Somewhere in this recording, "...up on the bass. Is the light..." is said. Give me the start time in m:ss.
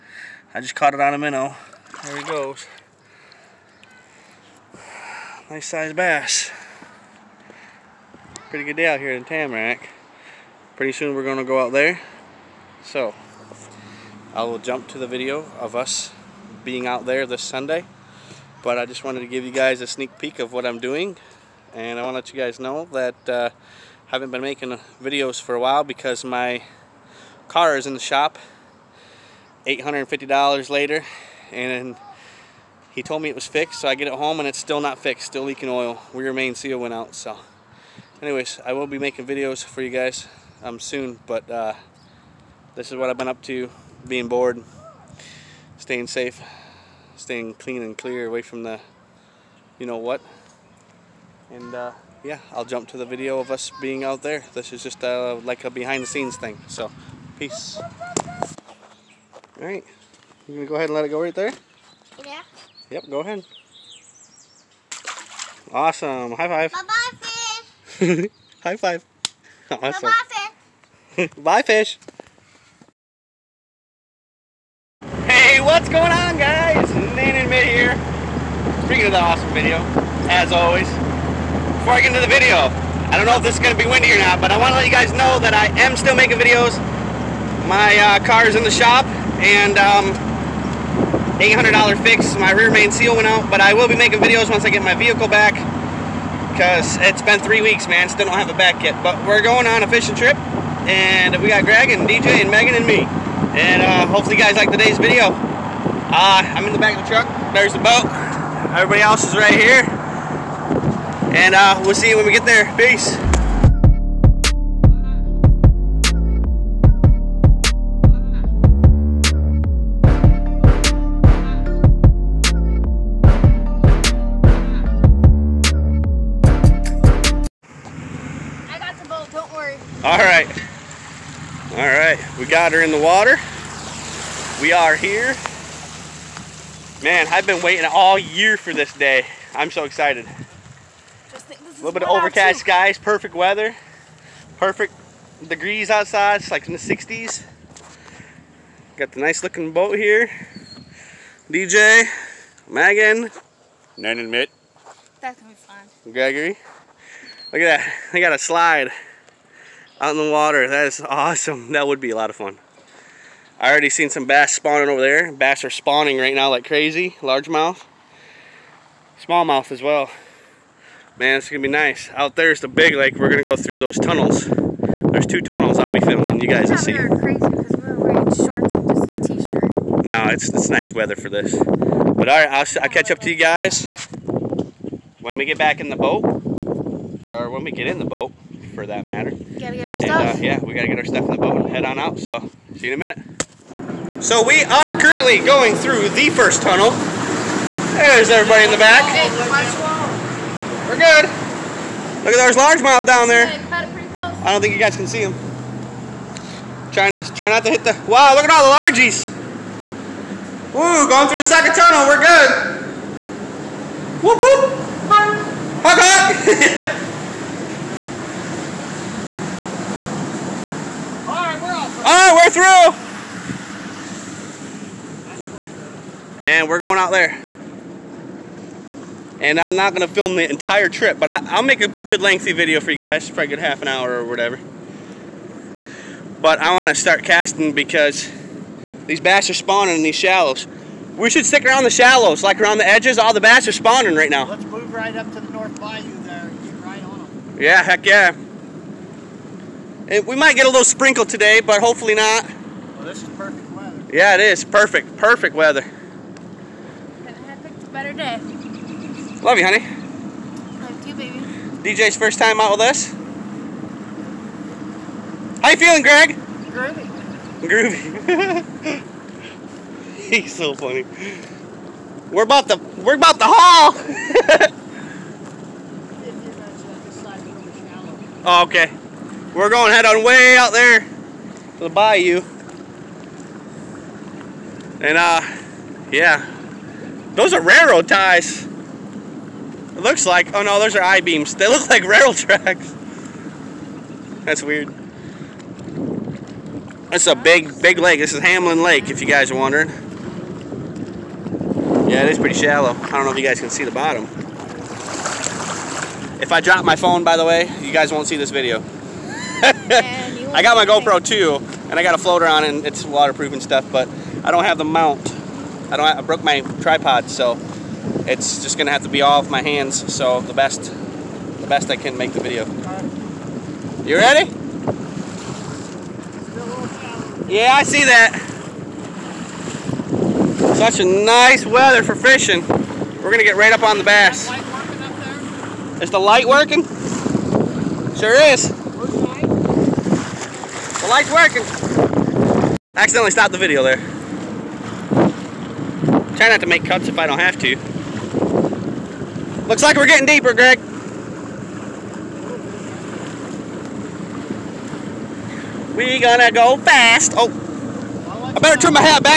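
5:33.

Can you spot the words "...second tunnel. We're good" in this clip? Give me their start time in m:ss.
3:31.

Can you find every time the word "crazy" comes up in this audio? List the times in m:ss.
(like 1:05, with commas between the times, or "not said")
2:46, 2:56.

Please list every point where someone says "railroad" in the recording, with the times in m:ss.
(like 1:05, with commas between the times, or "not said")
4:47, 4:52.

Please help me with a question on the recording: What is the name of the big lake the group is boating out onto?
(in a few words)
Hamlin Lake.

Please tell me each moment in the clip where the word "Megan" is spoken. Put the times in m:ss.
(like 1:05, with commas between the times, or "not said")
1:42, 2:32.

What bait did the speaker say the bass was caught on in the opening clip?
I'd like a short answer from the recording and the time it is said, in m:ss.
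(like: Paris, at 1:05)
minnow, at 0:01.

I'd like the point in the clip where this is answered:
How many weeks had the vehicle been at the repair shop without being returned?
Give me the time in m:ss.
1:37.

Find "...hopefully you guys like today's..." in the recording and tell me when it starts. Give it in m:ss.
1:44.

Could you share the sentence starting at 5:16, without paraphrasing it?
Have, I broke my tripod, so it's just gonna have to be all off my hands.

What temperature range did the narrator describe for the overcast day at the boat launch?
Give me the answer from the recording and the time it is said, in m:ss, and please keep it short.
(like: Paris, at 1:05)
the 60s, at 2:26.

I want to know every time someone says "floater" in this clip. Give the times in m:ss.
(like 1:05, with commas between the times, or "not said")
5:12.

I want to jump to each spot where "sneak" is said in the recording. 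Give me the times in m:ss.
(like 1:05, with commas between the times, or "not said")
0:19.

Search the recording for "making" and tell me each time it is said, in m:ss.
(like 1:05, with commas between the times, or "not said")
0:24, 0:38, 1:26, 1:33.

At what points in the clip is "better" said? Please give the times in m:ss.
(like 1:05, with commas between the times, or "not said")
4:17, 5:58.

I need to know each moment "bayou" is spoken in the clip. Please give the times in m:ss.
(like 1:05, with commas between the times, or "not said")
4:05, 4:41.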